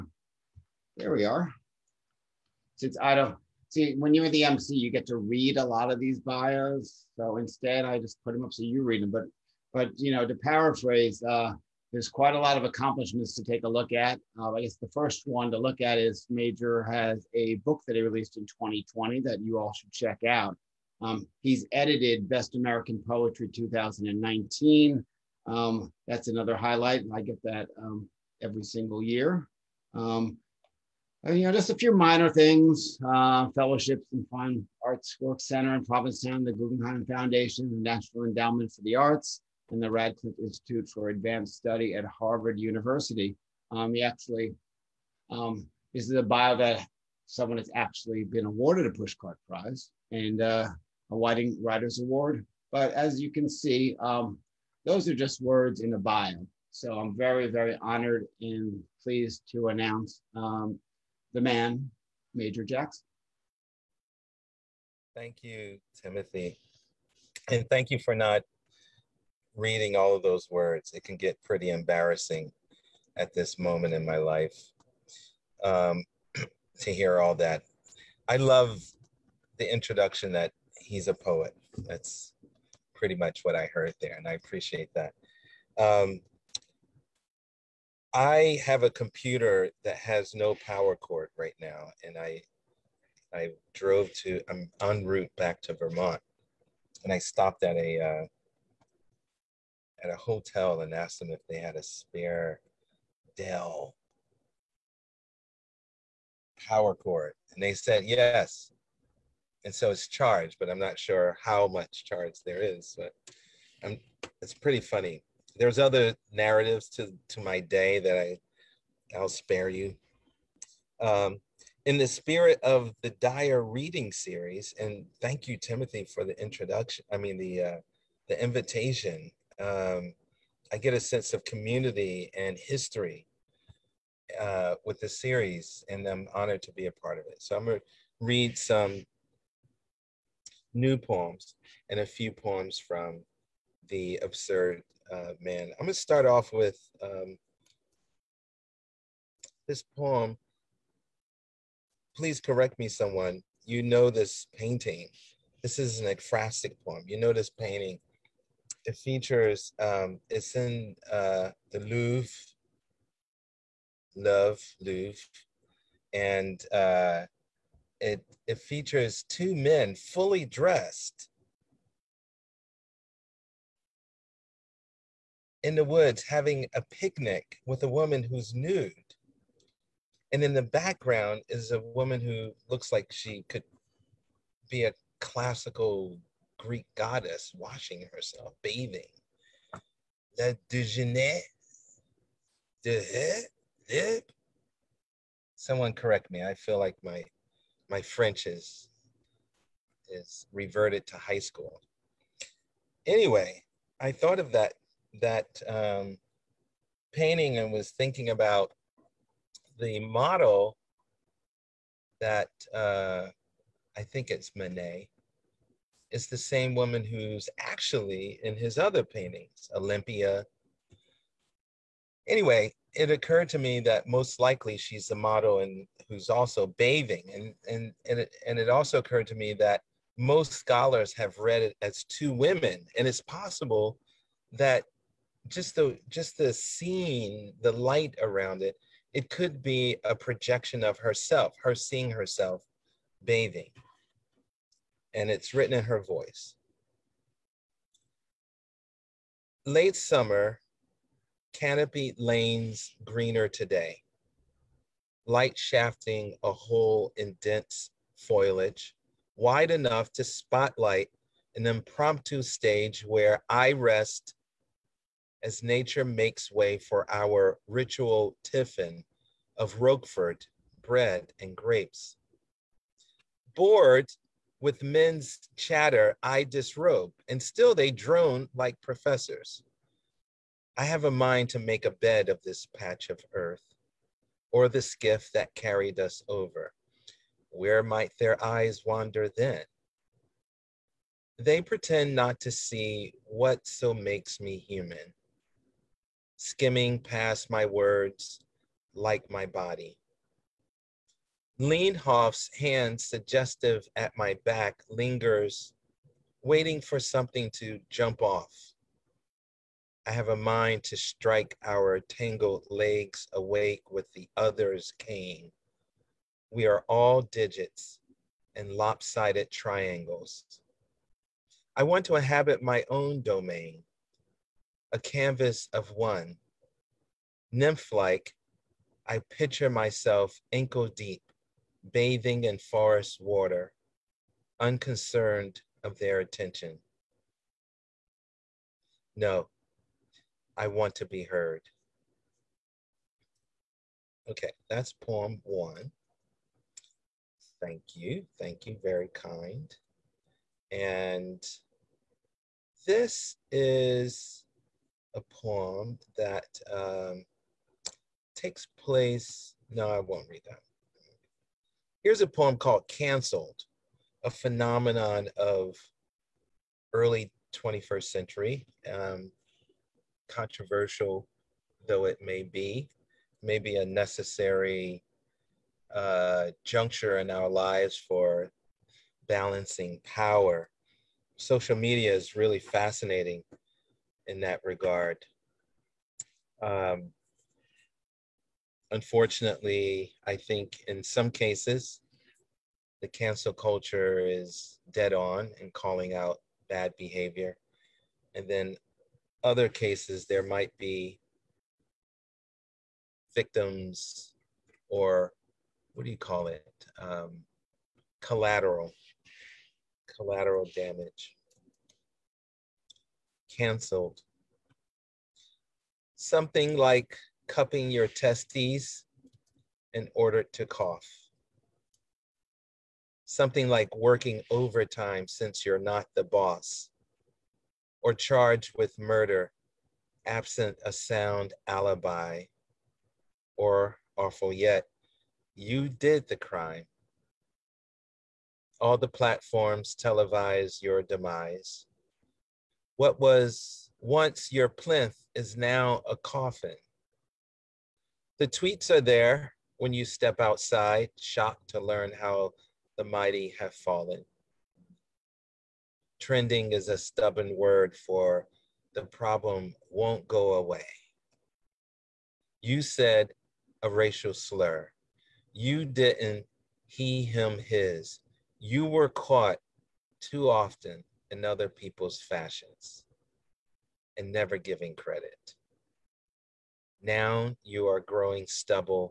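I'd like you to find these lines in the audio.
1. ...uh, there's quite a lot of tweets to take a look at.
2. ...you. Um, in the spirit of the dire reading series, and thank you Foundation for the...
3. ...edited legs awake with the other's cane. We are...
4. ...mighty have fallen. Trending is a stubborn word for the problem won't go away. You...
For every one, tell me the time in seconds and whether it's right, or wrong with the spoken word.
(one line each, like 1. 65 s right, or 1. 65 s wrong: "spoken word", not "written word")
1. 11 s wrong: "accomplishments", not "tweets"
2. 119 s wrong: "Timothy", not "Foundation"
3. 311 s wrong: "tangled", not "edited"
4. 453 s right.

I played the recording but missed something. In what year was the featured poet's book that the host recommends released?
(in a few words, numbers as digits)
2020.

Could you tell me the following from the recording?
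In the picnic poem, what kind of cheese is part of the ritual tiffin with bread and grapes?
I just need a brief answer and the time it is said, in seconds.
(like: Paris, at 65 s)
Roquefort, at 269 s.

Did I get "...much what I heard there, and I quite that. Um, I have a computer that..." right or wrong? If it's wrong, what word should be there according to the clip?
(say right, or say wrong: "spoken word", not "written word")
wrong: "appreciate", not "quite".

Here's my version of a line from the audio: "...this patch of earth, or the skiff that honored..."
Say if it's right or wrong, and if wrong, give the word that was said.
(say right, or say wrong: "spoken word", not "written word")
wrong: "carried", not "honored".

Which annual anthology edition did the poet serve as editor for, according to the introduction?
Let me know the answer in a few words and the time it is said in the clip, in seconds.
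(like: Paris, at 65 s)
Best American Poetry 2019, at 22 s.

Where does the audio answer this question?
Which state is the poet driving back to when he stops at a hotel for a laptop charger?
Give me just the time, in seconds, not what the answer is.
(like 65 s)
95 s.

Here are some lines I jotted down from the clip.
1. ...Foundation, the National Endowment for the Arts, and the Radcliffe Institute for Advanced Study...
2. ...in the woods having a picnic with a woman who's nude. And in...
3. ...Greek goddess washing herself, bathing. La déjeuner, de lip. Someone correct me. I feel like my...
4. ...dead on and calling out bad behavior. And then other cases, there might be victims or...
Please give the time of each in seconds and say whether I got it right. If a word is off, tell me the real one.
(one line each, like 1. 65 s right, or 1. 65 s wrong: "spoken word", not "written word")
1. 37 s right
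2. 175 s right
3. 186 s right
4. 394 s right.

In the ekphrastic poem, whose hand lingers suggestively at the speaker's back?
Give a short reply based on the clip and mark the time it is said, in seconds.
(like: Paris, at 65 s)
Leenhoff, at 301 s.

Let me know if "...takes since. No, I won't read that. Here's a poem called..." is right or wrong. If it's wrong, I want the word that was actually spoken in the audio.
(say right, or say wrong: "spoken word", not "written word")
wrong: "place", not "since".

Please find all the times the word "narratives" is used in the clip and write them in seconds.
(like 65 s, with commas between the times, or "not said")
116 s.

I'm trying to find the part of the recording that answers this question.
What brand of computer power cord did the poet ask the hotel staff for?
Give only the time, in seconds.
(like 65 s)
103 s.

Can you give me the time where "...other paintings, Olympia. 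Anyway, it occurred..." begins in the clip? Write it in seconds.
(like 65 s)
218 s.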